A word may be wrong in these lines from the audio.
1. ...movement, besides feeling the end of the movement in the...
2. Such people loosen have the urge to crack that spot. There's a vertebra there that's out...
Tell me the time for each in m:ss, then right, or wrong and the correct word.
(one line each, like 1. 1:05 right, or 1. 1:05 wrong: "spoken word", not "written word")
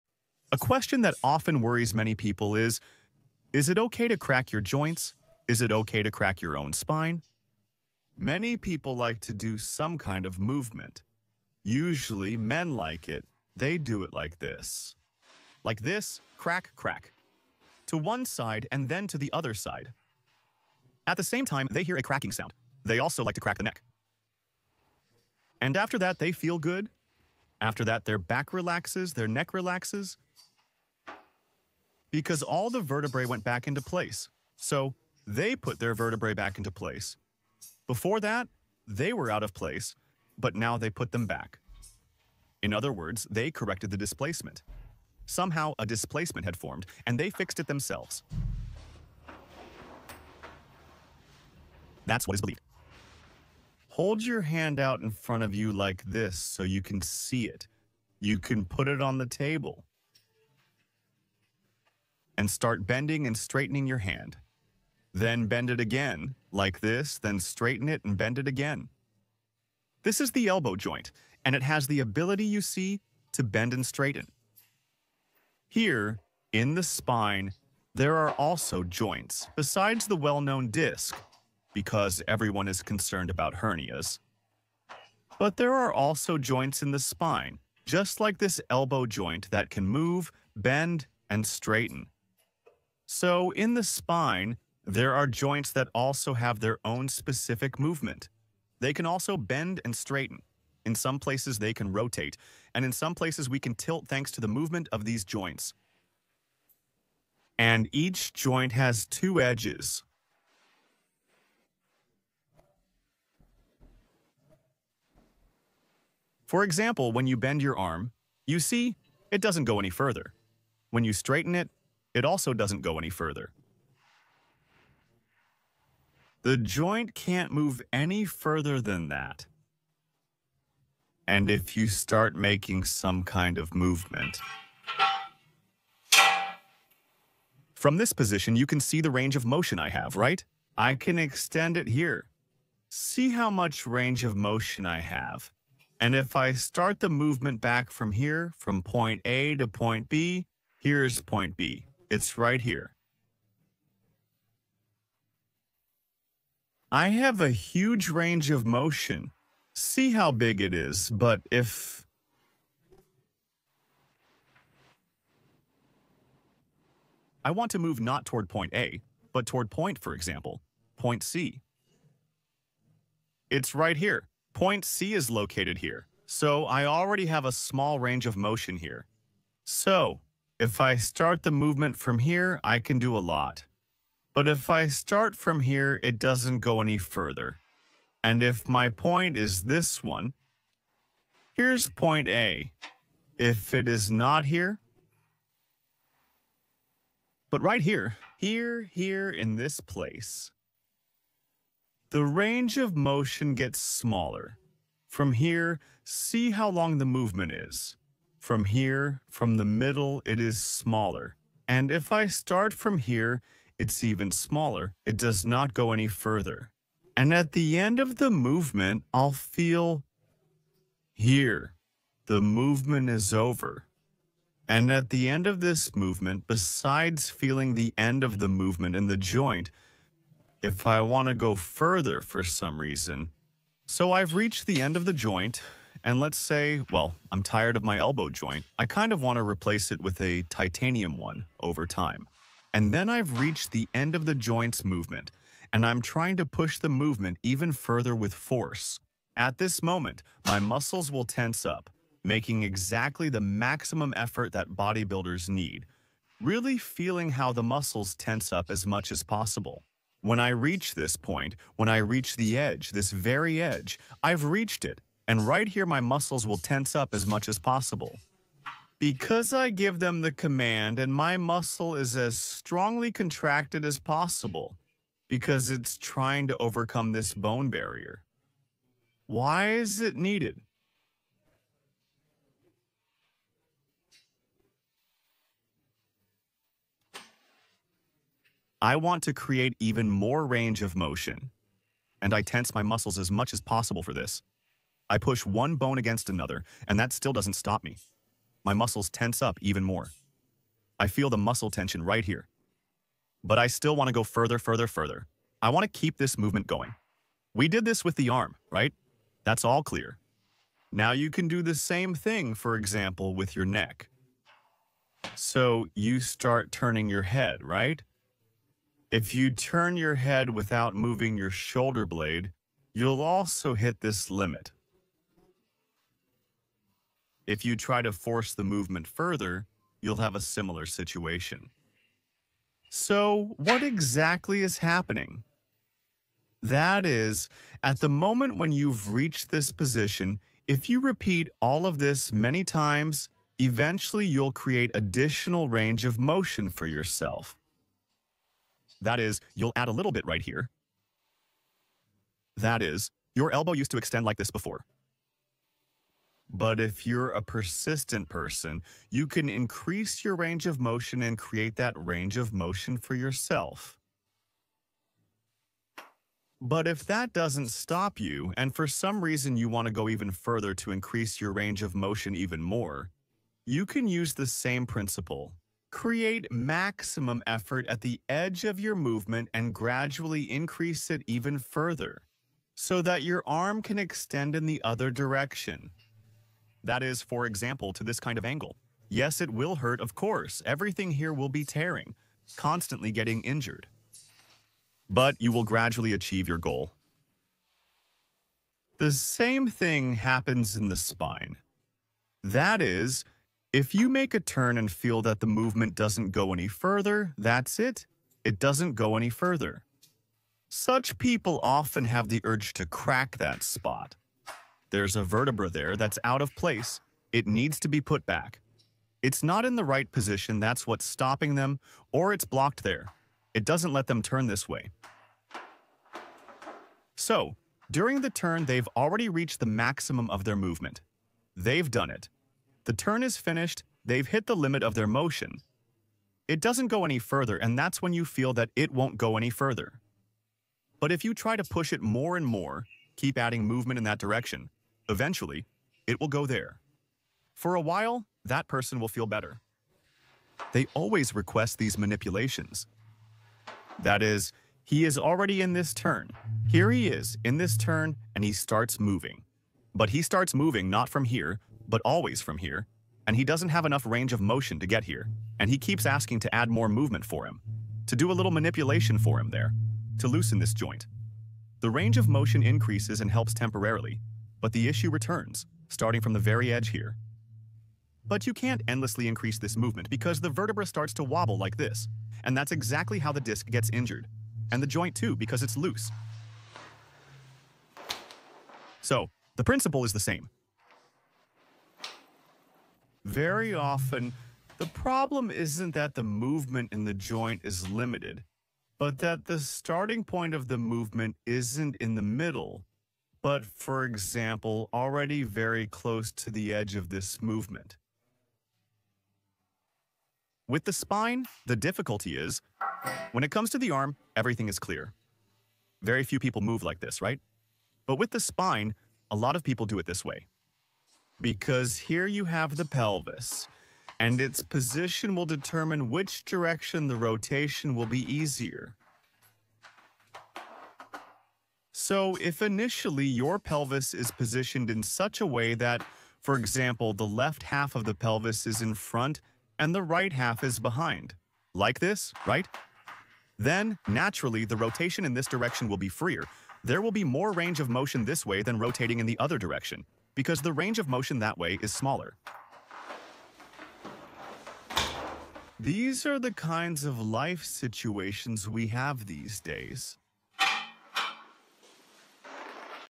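1. 3:45 right
2. 6:50 wrong: "often", not "loosen".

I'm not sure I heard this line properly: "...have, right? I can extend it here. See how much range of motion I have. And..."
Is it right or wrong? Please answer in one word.
right.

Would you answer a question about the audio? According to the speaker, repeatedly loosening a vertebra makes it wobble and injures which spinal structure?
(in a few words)
the disc.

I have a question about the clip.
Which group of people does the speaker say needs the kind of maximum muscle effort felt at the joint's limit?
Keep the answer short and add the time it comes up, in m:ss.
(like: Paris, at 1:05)
bodybuilders, at 4:14.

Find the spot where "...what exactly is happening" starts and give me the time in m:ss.
5:33.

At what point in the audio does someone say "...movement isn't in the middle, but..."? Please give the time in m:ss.
8:20.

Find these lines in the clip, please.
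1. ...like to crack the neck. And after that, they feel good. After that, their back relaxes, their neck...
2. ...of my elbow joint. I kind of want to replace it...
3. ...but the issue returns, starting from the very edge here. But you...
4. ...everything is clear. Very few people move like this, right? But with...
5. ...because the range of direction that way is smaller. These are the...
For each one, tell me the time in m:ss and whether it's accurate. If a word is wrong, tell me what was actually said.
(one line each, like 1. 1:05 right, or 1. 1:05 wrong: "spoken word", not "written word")
1. 0:23 right
2. 3:57 right
3. 7:54 right
4. 8:34 right
5. 9:10 wrong: "motion", not "direction".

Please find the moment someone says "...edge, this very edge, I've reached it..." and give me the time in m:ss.
4:22.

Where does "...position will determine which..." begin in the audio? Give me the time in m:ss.
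8:44.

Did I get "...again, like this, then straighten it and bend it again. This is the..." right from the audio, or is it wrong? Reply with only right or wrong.
right.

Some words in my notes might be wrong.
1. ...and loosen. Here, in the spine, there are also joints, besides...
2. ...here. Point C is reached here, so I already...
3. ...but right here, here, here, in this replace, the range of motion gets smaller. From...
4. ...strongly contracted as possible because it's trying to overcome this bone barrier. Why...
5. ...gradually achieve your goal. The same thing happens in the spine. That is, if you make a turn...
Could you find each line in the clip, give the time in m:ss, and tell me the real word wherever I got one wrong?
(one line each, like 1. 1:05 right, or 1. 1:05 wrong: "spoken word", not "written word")
1. 1:13 wrong: "straighten", not "loosen"
2. 2:53 wrong: "located", not "reached"
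3. 3:17 wrong: "place", not "replace"
4. 4:32 right
5. 6:35 right.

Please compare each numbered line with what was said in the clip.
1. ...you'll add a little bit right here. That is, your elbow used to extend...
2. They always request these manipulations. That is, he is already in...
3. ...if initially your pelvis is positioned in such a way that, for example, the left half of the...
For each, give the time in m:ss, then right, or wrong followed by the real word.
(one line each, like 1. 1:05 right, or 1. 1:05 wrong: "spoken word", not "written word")
1. 5:49 right
2. 7:30 right
3. 8:52 right.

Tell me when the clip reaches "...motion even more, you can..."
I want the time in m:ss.
6:11.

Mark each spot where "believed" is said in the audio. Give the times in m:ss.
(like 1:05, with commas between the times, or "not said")
0:52.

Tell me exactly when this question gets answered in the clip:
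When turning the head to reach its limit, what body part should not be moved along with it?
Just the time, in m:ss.
5:21.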